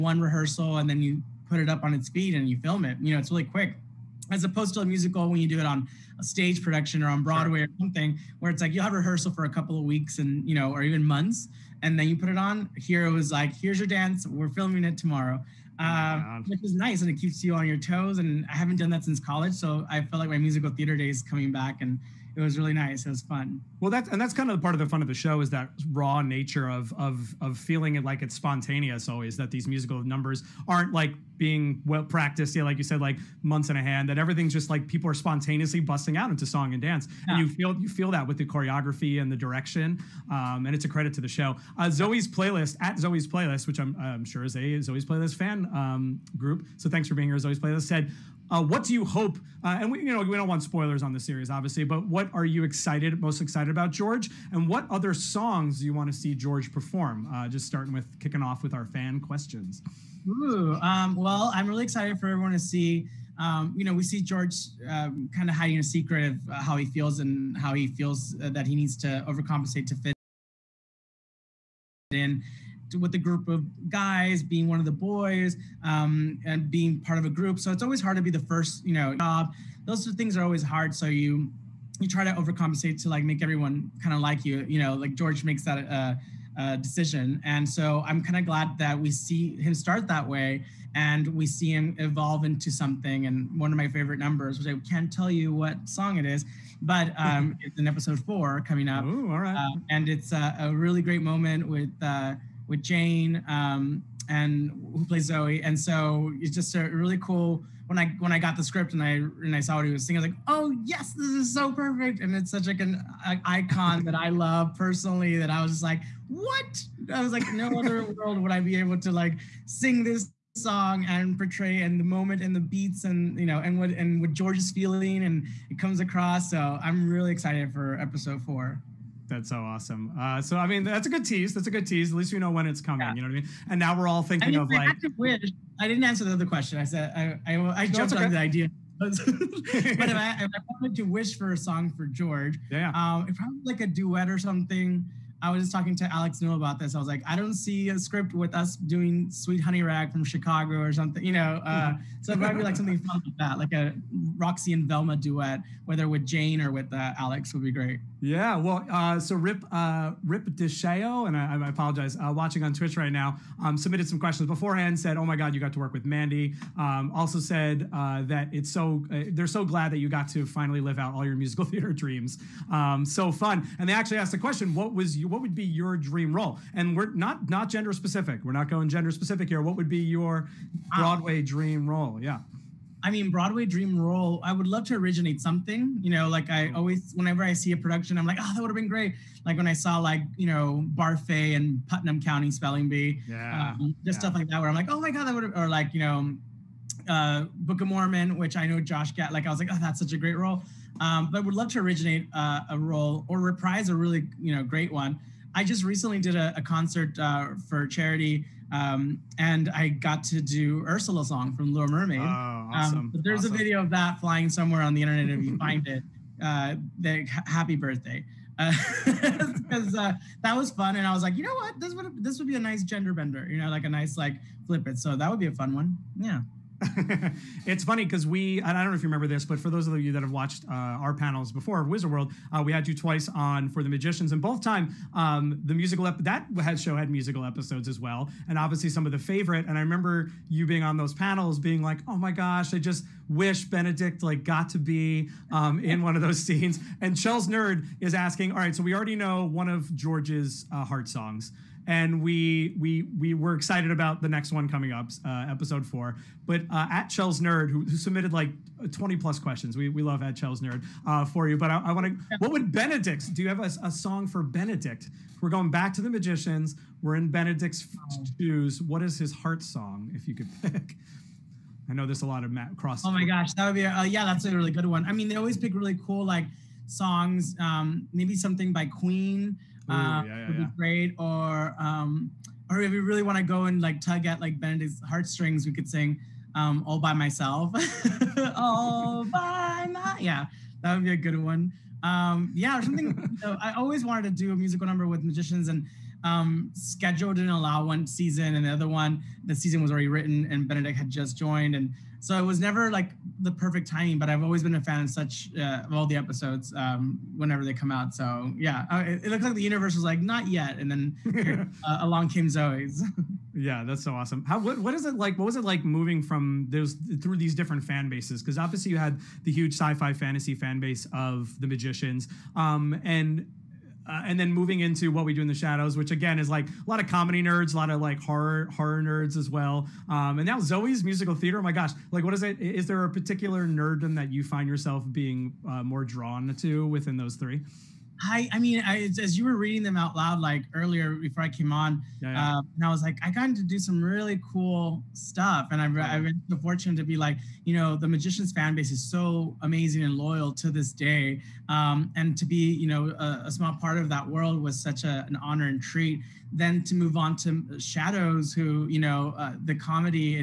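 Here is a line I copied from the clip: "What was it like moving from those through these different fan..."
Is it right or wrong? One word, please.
right.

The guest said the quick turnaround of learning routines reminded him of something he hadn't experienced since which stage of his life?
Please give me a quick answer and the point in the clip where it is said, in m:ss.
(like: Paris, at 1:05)
college, at 0:19.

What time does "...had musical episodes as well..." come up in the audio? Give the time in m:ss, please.
3:56.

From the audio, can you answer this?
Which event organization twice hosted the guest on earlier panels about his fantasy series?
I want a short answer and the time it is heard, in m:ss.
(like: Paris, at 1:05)
Wizard World, at 3:51.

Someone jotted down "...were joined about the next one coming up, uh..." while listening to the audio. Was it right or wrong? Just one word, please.
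wrong.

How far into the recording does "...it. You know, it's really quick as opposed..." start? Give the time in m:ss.
0:02.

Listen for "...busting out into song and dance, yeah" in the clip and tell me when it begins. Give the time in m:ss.
0:35.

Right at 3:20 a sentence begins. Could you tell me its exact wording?
Um, but would love to originate uh, a role or reprise a really, you know, great one.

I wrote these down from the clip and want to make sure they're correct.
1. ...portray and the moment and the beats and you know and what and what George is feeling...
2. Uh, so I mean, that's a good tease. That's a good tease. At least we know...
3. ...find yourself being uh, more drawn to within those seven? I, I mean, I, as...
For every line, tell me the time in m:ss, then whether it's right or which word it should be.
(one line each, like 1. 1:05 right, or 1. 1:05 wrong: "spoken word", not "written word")
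1. 2:01 right
2. 2:10 right
3. 5:34 wrong: "three", not "seven".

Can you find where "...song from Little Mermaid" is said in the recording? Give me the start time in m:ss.
3:31.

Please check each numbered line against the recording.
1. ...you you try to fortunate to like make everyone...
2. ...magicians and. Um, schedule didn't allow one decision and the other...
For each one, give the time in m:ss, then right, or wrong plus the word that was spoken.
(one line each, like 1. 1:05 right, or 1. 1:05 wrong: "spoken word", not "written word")
1. 1:21 wrong: "overcompensate", not "fortunate"
2. 4:55 wrong: "season", not "decision".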